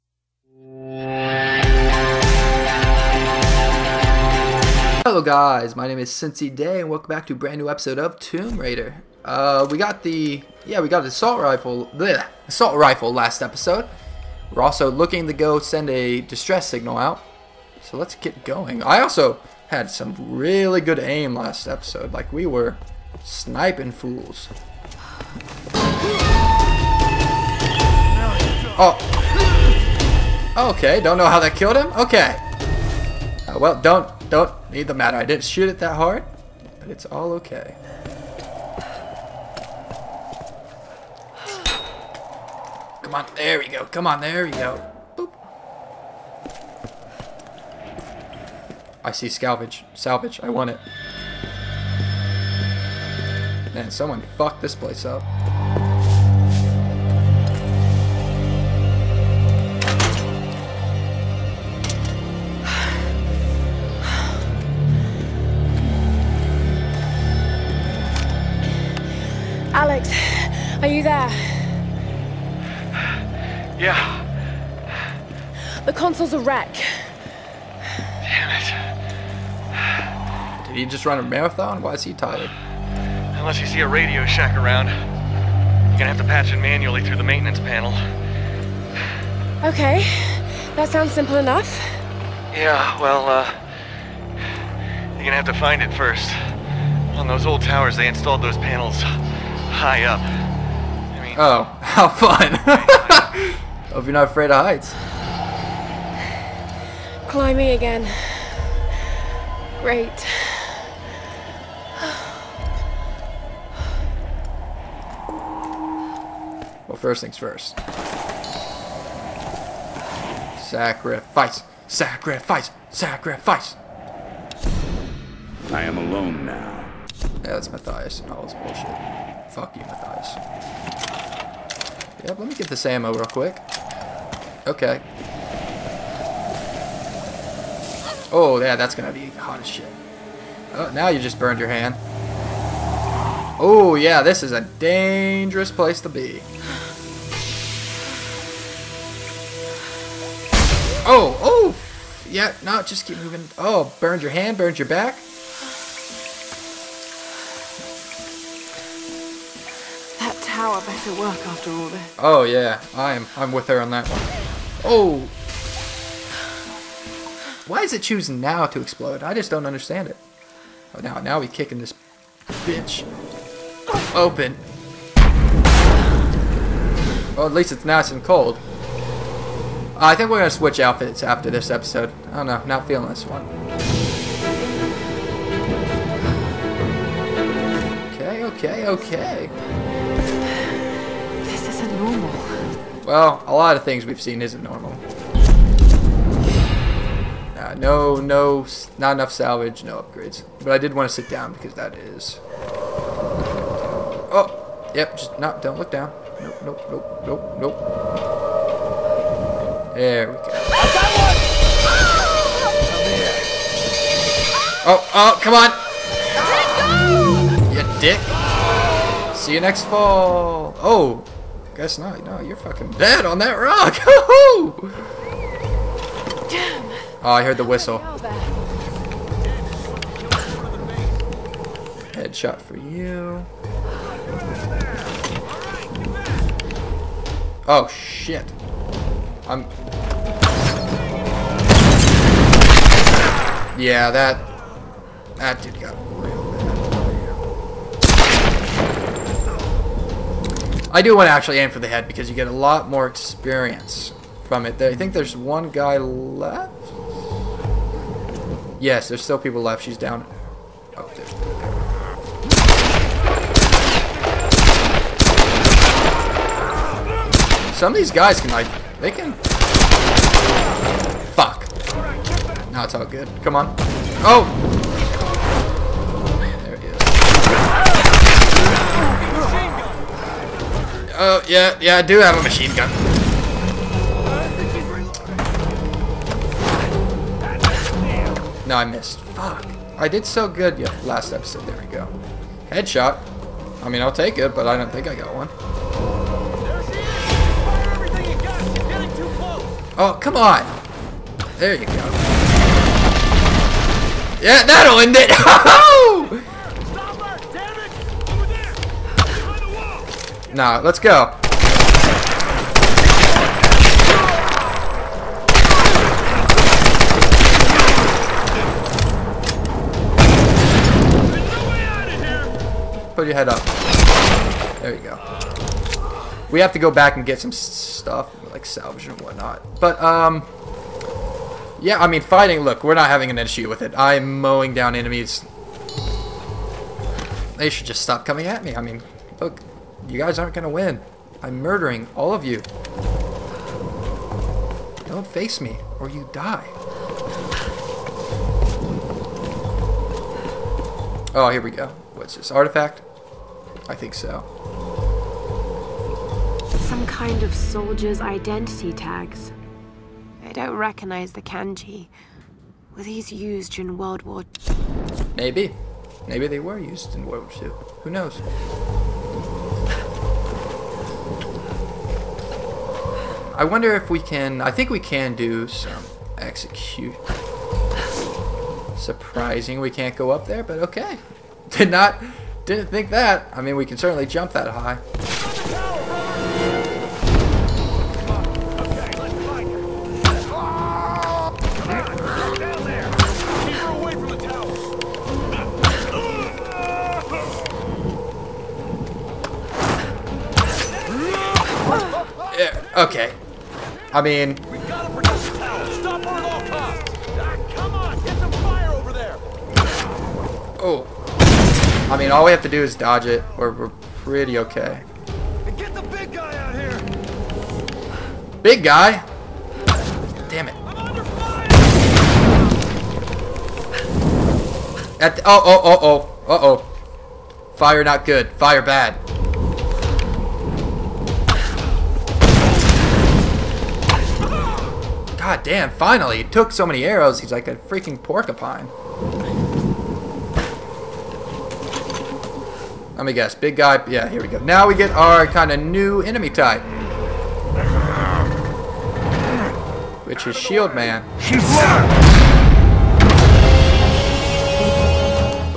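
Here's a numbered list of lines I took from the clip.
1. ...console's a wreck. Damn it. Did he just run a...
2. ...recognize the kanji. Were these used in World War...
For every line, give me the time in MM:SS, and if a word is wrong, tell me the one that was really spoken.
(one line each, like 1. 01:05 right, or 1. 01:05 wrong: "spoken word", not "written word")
1. 01:15 right
2. 06:00 right.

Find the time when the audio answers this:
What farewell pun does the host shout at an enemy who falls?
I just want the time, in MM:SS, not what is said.
03:39.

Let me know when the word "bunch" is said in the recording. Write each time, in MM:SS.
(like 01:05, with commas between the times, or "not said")
not said.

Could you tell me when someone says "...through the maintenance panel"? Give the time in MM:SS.
01:27.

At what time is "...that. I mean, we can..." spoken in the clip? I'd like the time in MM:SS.
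06:23.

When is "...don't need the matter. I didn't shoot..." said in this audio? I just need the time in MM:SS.
00:34.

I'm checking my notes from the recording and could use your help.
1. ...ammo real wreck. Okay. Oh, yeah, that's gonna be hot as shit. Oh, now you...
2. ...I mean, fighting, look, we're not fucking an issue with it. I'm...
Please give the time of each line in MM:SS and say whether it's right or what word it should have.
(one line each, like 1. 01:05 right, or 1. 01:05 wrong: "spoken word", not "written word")
1. 02:12 wrong: "quick", not "wreck"
2. 05:32 wrong: "having", not "fucking".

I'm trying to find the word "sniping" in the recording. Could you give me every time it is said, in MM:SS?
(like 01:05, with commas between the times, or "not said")
00:23.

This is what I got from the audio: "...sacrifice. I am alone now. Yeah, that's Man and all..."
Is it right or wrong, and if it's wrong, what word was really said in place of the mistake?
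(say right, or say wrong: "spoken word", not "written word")
wrong: "Mathias", not "Man".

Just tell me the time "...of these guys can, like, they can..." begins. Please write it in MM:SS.
04:27.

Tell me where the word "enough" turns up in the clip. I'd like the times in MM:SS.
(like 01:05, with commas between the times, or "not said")
01:31, 03:19.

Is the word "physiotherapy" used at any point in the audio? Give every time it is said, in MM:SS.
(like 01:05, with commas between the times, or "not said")
not said.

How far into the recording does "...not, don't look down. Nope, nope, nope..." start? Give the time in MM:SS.
03:25.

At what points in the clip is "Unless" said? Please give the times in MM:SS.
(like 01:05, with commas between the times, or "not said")
01:23.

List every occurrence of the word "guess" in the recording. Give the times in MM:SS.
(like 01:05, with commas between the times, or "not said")
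03:41, 07:23.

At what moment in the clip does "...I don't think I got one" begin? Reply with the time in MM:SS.
04:54.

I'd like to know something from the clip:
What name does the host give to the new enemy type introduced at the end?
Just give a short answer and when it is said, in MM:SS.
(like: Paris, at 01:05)
Shield Man, at 07:30.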